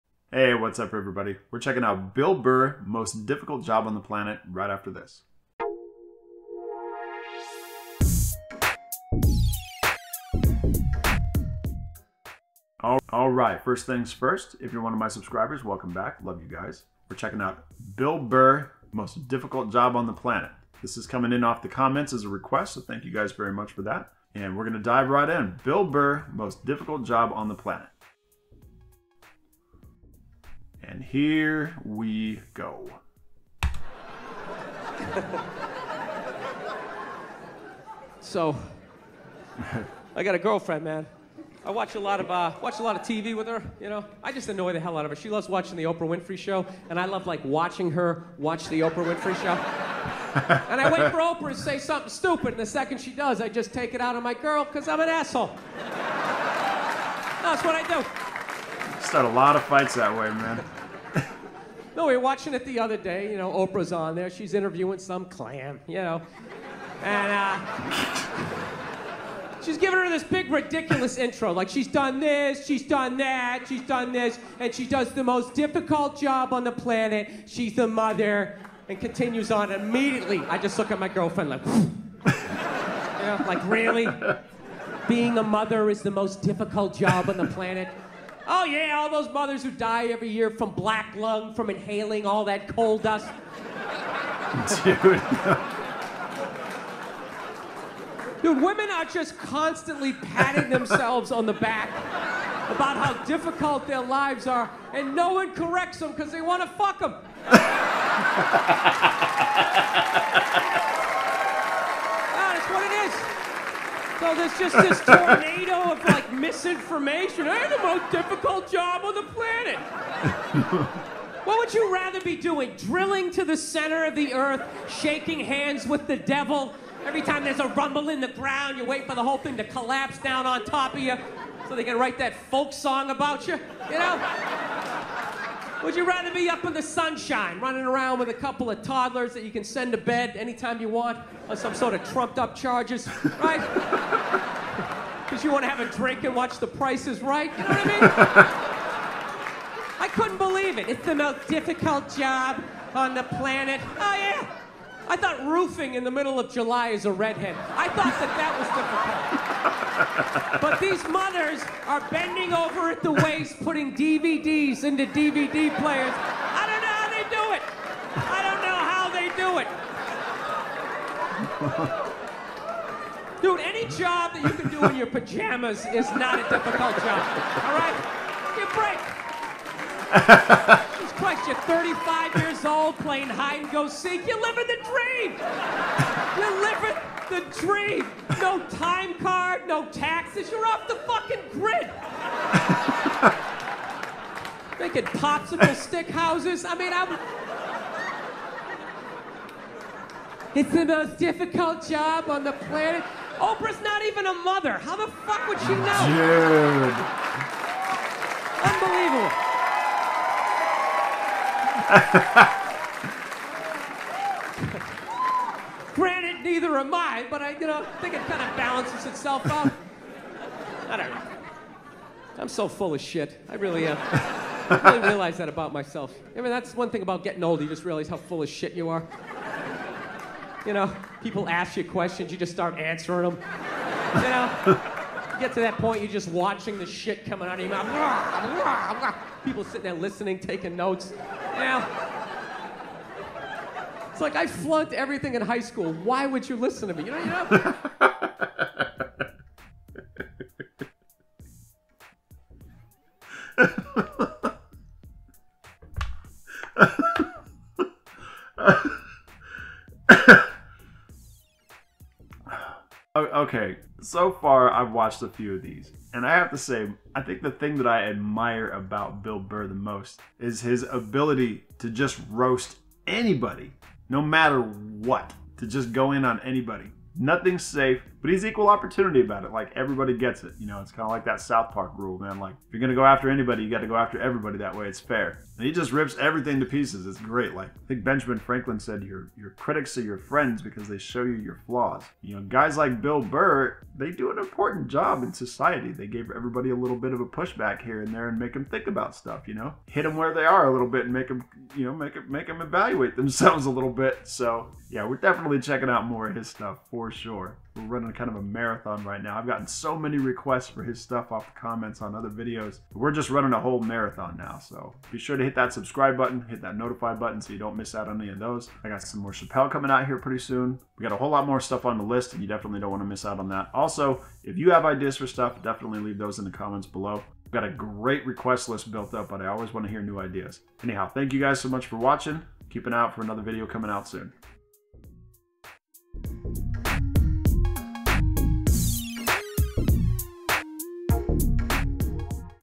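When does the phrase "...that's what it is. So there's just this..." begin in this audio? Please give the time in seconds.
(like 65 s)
112 s.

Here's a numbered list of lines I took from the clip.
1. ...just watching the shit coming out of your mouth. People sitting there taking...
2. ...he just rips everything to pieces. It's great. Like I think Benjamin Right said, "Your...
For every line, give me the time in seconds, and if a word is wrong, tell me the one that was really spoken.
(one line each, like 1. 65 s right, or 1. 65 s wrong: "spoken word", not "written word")
1. 236 s wrong: "listening", not "taking"
2. 285 s wrong: "Franklin", not "Right".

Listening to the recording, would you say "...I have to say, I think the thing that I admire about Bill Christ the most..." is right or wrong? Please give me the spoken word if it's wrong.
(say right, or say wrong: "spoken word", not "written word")
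wrong: "Burr", not "Christ".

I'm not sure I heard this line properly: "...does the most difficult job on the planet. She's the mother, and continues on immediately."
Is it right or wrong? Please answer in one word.
right.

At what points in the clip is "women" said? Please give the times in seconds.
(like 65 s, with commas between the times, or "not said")
98 s.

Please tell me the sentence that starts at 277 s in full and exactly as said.
Nothing's safe, but he's equal opportunity about it.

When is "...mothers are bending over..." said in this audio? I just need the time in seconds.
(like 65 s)
161 s.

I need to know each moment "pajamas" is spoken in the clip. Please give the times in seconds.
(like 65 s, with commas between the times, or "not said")
175 s.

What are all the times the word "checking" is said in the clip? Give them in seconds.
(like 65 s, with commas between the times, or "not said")
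1 s, 17 s, 305 s.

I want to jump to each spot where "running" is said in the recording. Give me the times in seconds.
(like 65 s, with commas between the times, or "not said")
137 s, 307 s, 313 s.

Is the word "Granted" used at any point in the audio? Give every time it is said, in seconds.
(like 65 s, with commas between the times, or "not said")
215 s.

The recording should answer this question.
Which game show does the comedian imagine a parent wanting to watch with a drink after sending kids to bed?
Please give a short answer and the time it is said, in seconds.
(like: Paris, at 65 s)
The Price Is Right, at 146 s.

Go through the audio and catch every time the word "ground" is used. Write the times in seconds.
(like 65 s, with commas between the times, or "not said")
128 s.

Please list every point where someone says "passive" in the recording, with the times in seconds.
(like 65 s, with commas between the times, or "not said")
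not said.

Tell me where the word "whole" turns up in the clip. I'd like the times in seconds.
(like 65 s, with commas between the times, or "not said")
129 s, 313 s, 321 s.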